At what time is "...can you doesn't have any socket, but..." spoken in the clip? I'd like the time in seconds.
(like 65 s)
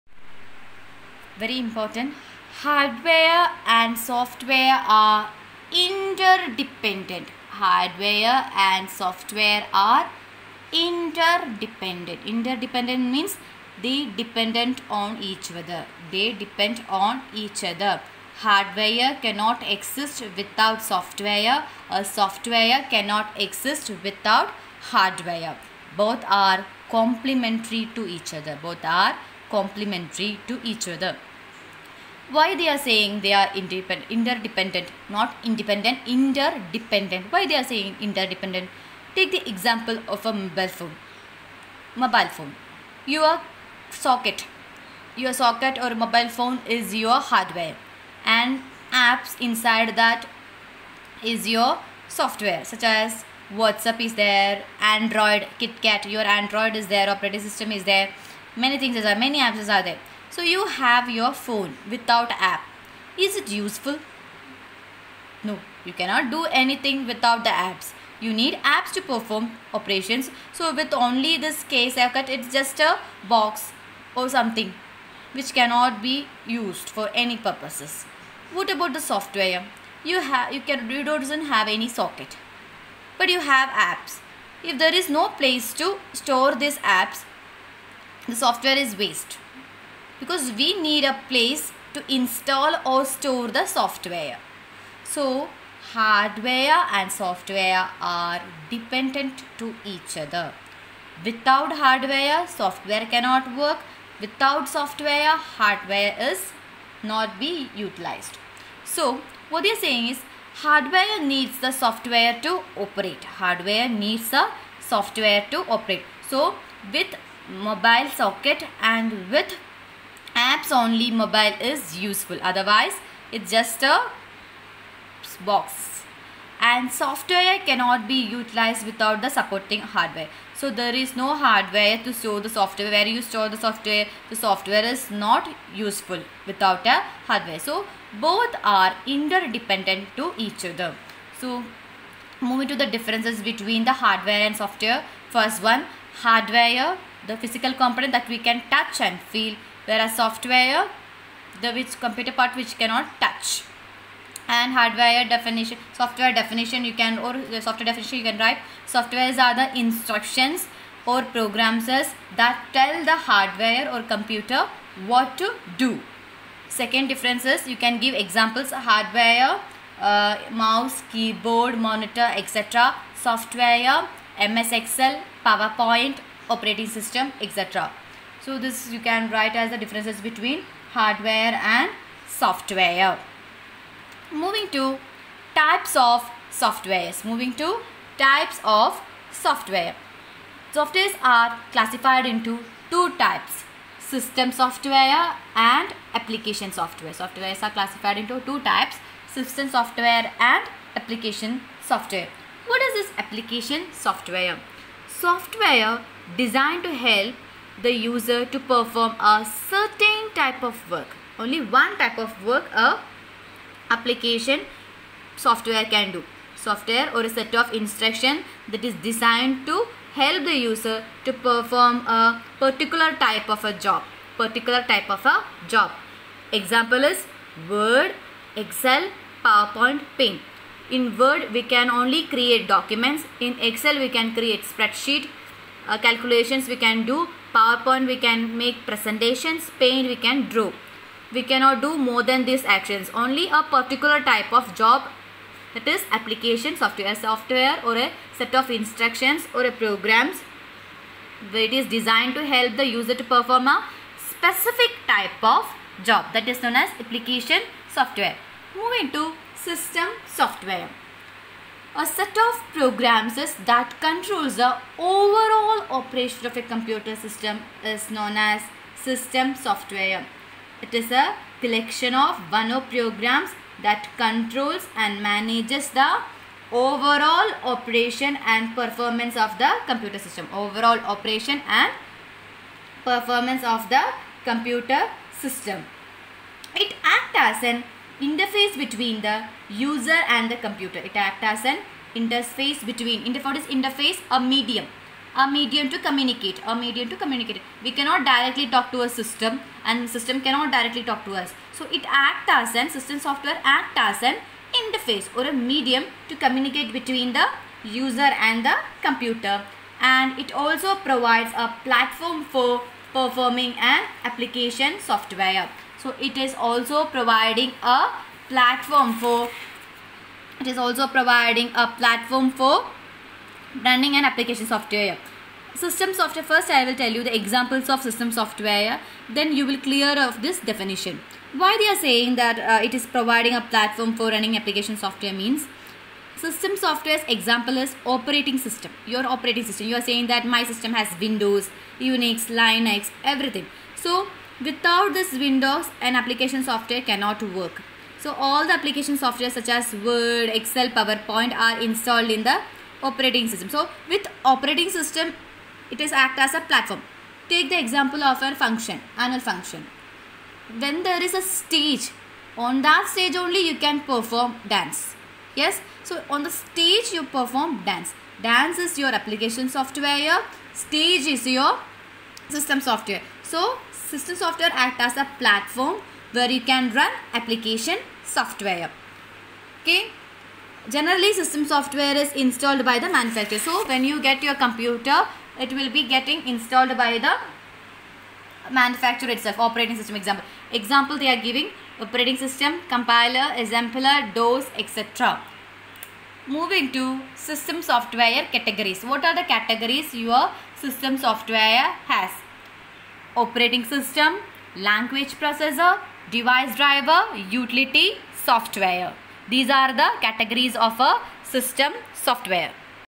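80 s.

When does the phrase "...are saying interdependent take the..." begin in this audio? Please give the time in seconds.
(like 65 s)
37 s.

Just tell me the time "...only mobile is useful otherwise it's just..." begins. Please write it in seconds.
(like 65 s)
120 s.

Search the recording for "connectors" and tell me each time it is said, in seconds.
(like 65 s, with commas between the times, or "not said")
not said.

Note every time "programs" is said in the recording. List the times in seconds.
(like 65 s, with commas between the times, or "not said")
161 s, 249 s, 262 s, 272 s.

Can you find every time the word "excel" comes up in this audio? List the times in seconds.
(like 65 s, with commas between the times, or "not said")
174 s, 228 s, 233 s, 350 s.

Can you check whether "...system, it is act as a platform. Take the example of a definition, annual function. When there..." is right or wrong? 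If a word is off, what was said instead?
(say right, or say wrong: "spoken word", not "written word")
wrong: "function", not "definition".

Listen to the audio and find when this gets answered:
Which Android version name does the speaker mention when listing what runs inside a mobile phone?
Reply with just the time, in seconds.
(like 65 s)
55 s.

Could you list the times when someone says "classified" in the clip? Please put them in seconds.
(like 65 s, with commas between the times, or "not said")
191 s, 197 s.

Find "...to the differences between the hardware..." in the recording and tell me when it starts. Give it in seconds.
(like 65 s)
142 s.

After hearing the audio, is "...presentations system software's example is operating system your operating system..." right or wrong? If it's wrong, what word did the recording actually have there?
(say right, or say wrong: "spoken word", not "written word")
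wrong: "means", not "presentations".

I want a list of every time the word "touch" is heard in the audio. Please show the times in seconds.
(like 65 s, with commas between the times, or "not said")
148 s, 153 s.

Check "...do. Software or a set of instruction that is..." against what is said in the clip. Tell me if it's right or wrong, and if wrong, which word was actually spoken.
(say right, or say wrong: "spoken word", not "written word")
right.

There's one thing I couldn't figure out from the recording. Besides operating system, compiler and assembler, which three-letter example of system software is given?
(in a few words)
DOS.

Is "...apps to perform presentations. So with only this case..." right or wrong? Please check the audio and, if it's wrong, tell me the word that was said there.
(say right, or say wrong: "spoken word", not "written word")
wrong: "operations", not "presentations".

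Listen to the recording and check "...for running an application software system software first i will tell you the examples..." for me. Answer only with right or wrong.
right.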